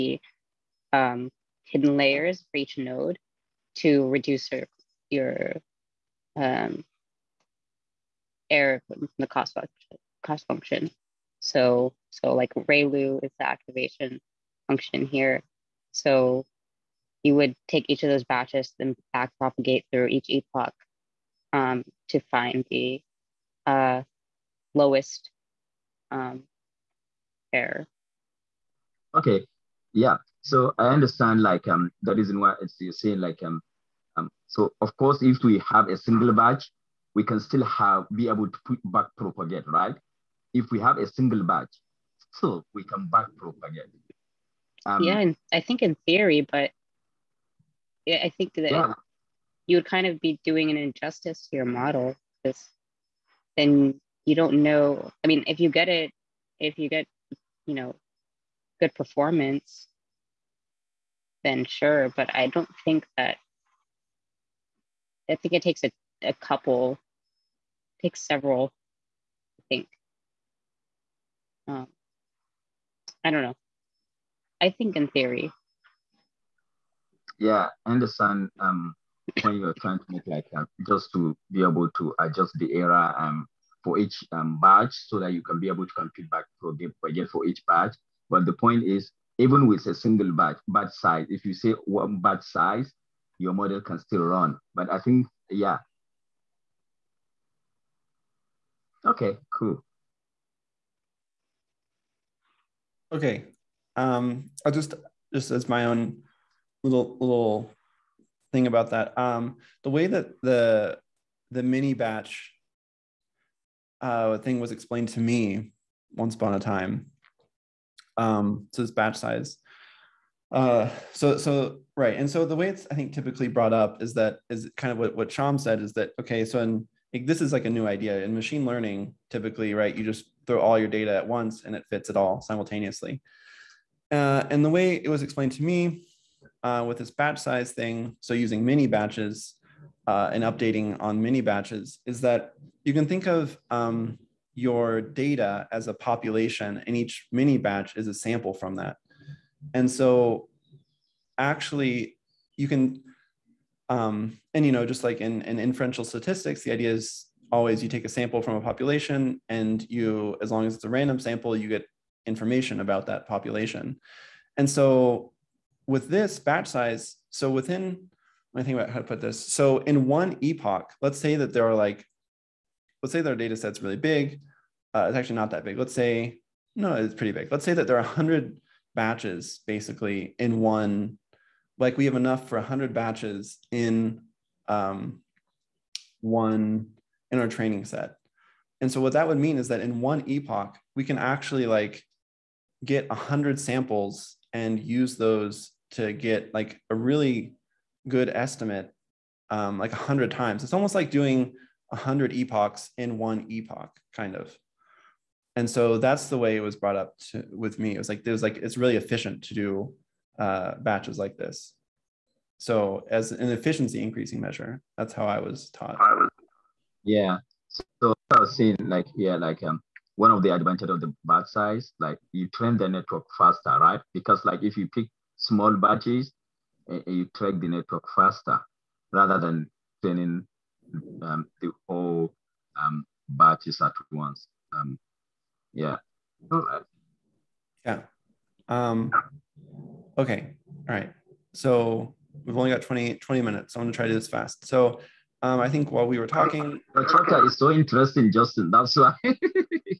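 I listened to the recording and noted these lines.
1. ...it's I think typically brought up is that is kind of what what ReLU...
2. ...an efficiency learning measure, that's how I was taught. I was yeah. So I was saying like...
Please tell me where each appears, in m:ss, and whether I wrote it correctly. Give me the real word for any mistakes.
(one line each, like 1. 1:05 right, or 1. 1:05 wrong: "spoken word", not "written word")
1. 2:02 wrong: "Sham", not "ReLU"
2. 3:33 wrong: "increasing", not "learning".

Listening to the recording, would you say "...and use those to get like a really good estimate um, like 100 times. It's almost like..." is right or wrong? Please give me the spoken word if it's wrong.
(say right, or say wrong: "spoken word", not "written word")
right.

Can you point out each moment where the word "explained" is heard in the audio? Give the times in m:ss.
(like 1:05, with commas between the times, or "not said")
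1:54, 2:15.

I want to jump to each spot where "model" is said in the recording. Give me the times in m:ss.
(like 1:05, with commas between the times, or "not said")
0:51, 1:33.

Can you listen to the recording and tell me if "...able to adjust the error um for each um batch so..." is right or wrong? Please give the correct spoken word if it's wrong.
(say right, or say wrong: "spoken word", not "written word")
right.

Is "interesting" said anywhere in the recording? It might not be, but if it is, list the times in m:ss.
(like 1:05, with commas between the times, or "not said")
4:07.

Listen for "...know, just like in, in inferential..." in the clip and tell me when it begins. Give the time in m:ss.
2:34.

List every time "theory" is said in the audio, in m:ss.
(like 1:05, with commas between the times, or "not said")
0:46, 1:15.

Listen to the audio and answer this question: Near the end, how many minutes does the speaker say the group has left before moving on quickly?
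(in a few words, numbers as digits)
20.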